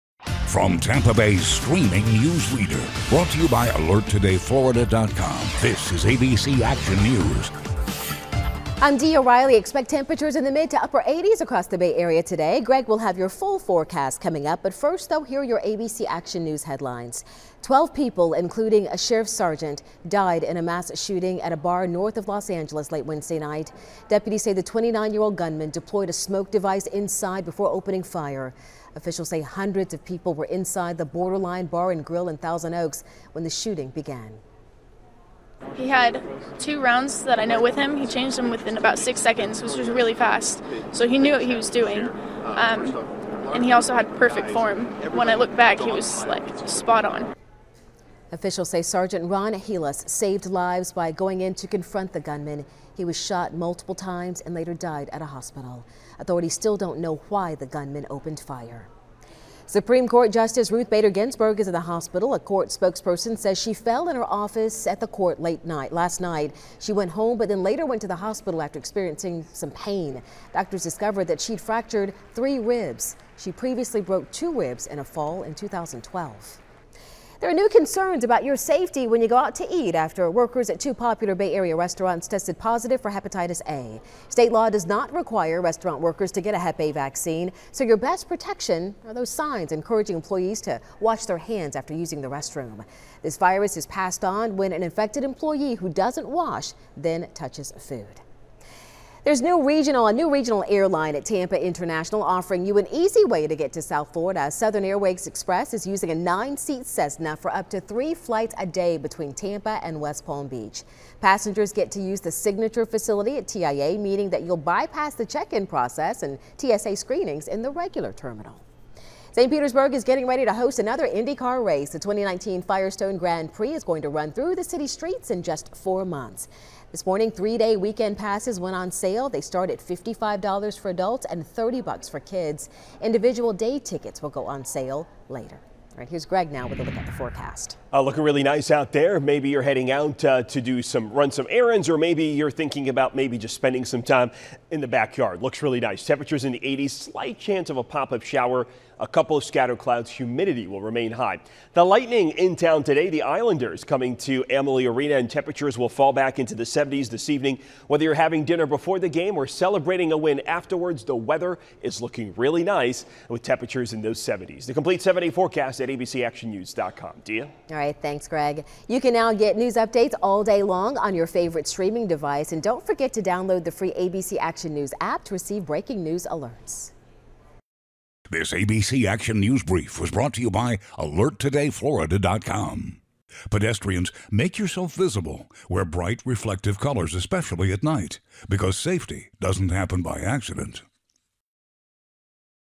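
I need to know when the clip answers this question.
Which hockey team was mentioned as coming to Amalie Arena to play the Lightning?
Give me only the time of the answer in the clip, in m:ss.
2:33.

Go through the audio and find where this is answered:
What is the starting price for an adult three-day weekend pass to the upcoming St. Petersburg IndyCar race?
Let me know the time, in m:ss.
2:09.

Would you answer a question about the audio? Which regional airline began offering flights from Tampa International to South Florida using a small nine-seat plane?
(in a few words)
Southern Airways Express.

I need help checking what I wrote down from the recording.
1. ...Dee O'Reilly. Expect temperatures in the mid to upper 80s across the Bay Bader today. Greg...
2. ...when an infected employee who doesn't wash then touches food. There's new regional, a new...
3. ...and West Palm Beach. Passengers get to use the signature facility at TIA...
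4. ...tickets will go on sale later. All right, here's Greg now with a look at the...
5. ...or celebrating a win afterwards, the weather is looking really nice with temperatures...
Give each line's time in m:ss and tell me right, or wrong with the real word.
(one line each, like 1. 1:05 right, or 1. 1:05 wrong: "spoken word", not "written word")
1. 0:08 wrong: "Area", not "Bader"
2. 1:34 right
3. 1:49 right
4. 2:13 right
5. 2:39 right.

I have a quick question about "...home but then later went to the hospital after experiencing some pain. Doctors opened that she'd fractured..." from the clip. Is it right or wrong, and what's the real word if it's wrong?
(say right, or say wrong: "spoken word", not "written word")
wrong: "discovered", not "opened".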